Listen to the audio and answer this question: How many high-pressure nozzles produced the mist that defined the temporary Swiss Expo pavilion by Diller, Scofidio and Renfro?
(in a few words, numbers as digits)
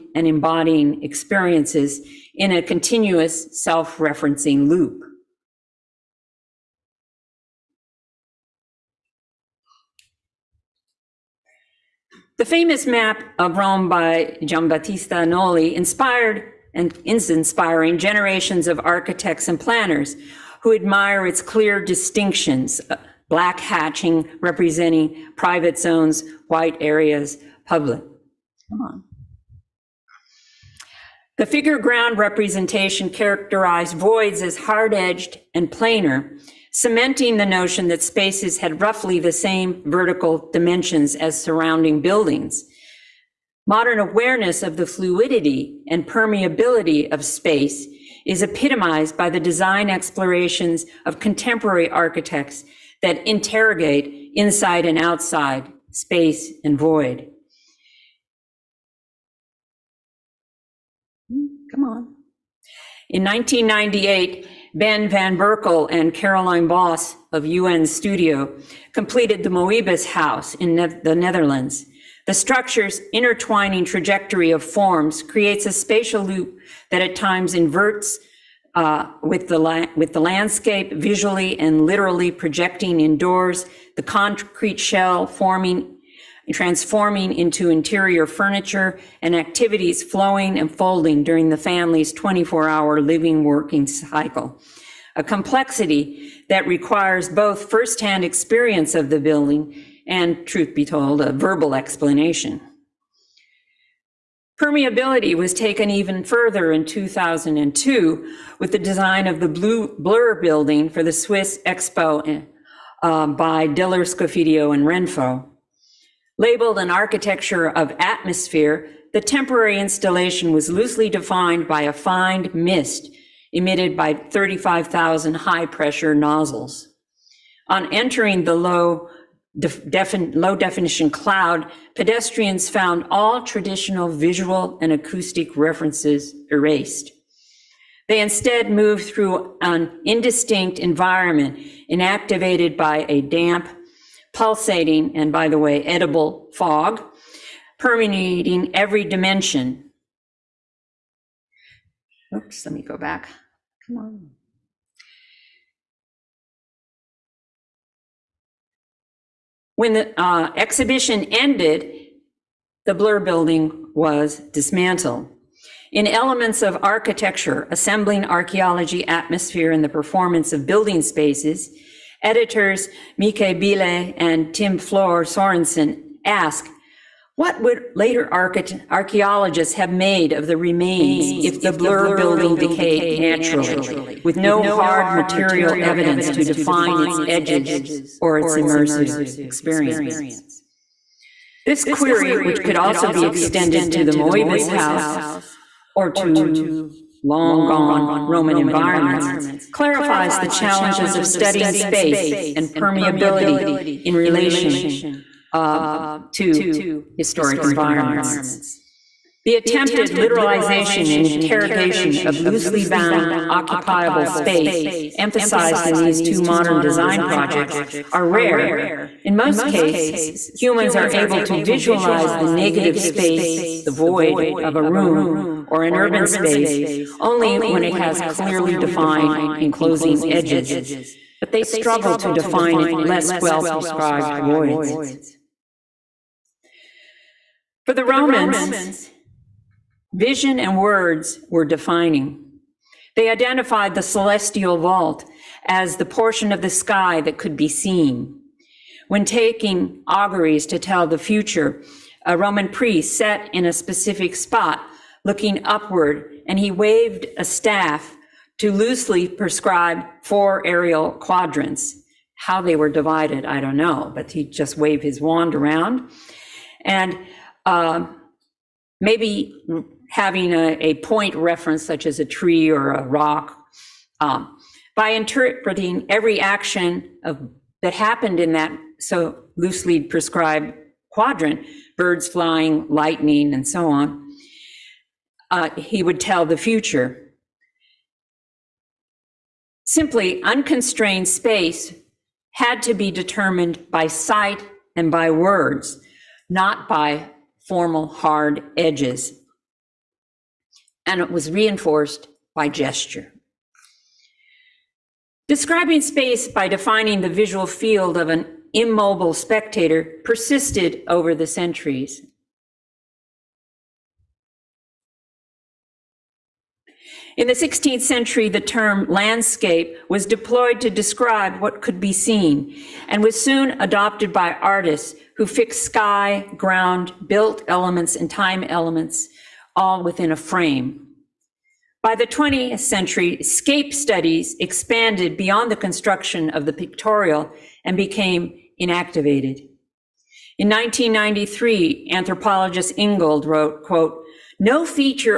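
35,000.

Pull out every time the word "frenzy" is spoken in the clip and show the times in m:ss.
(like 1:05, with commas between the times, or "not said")
not said.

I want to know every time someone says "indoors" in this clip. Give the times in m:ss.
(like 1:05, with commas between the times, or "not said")
1:22.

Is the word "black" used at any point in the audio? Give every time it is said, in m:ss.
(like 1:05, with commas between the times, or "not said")
0:23.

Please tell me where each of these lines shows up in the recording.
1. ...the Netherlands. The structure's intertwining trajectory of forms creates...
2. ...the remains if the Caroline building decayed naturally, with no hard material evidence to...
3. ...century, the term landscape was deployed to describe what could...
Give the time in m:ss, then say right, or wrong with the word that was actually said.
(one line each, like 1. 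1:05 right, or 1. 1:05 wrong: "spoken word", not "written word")
1. 1:11 right
2. 3:00 wrong: "Blur", not "Caroline"
3. 5:17 right.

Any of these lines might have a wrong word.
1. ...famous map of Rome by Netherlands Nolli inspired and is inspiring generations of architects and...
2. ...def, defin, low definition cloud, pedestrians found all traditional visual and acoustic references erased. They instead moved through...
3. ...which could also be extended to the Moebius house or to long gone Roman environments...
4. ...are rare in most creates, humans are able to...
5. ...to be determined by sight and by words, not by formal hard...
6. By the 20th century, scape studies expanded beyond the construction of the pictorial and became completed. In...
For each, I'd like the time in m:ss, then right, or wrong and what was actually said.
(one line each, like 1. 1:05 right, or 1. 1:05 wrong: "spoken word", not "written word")
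1. 0:12 wrong: "Giambattista", not "Netherlands"
2. 2:09 right
3. 3:12 right
4. 3:38 wrong: "cases", not "creates"
5. 4:52 right
6. 5:32 wrong: "enactivated", not "completed".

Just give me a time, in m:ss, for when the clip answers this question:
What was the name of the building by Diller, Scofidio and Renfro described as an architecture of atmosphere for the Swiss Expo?
1:49.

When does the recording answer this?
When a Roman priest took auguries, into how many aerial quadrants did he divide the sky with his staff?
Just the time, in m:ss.
4:20.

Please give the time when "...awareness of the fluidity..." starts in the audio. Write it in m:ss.
0:43.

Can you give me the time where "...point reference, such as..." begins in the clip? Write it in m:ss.
4:30.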